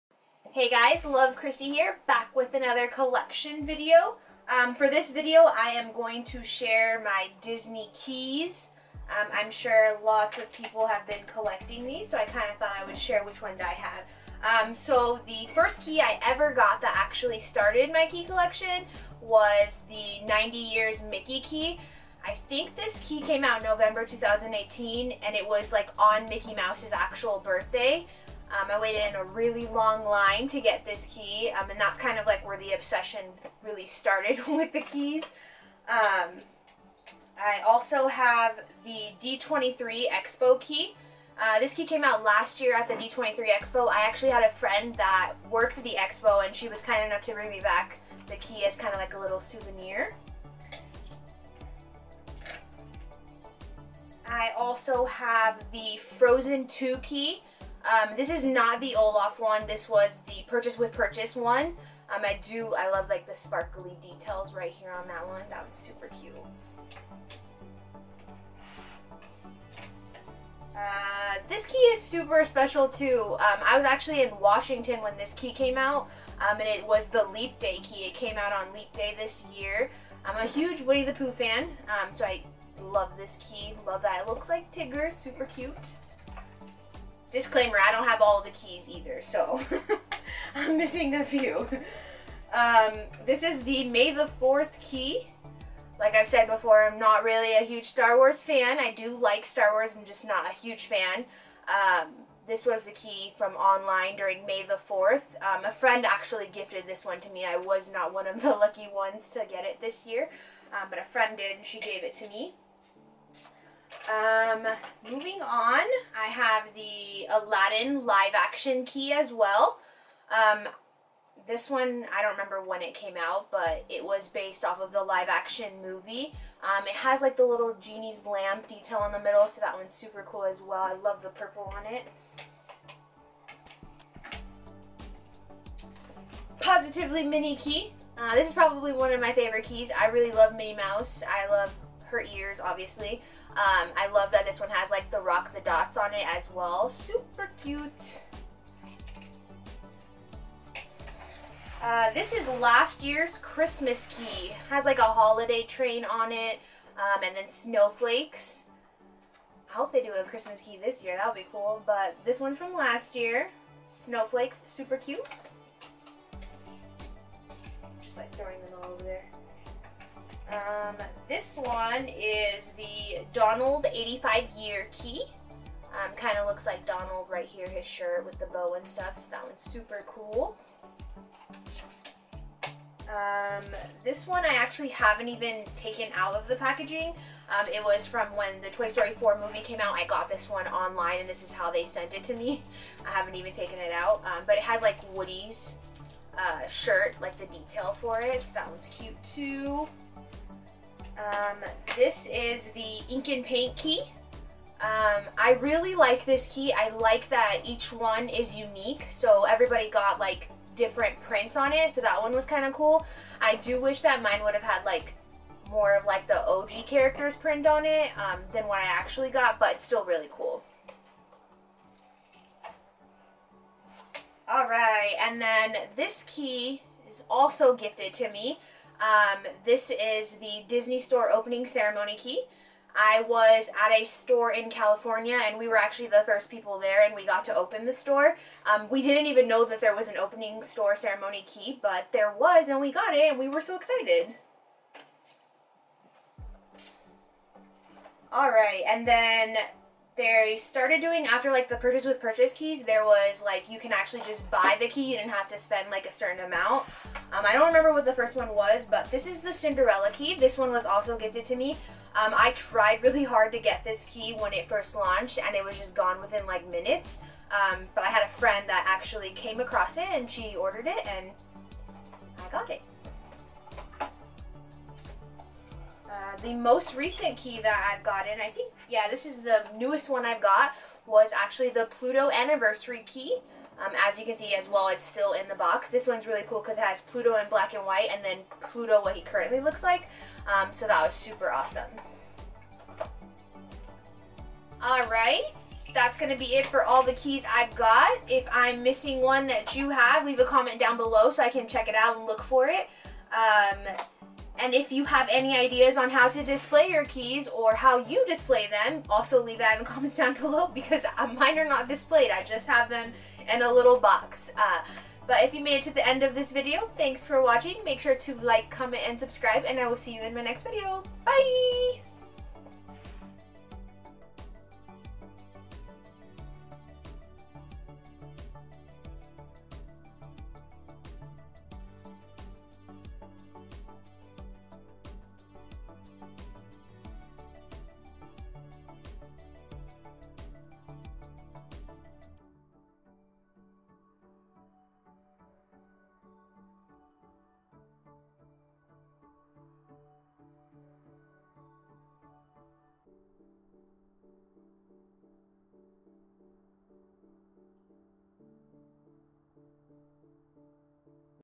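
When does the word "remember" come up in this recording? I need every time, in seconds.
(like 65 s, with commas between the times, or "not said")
122 s, 257 s.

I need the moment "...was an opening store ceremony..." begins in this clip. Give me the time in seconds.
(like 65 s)
239 s.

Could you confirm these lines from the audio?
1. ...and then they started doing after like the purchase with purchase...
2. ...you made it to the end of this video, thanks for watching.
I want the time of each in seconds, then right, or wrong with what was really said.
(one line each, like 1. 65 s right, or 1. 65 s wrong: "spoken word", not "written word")
1. 248 s right
2. 315 s right.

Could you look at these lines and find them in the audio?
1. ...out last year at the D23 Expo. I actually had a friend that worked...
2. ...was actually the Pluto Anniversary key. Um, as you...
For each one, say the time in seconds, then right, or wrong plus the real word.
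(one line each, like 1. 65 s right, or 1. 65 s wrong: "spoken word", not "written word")
1. 42 s right
2. 281 s right.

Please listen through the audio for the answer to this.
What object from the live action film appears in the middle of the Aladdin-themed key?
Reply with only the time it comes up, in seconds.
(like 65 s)
127 s.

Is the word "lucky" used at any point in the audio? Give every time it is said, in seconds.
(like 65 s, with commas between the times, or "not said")
108 s.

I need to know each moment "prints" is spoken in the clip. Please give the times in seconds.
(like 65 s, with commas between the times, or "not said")
211 s, 217 s.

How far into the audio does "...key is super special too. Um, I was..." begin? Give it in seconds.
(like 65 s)
71 s.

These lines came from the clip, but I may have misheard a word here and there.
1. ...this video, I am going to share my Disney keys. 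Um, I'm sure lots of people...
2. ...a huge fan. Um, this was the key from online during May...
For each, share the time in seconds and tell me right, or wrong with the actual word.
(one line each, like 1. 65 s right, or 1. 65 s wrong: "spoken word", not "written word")
1. 4 s right
2. 100 s right.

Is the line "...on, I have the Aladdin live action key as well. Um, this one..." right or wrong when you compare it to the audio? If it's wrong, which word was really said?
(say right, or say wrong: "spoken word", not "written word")
right.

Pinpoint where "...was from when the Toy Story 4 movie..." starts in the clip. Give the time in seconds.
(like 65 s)
187 s.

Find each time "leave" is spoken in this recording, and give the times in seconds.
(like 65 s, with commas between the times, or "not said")
300 s, 309 s.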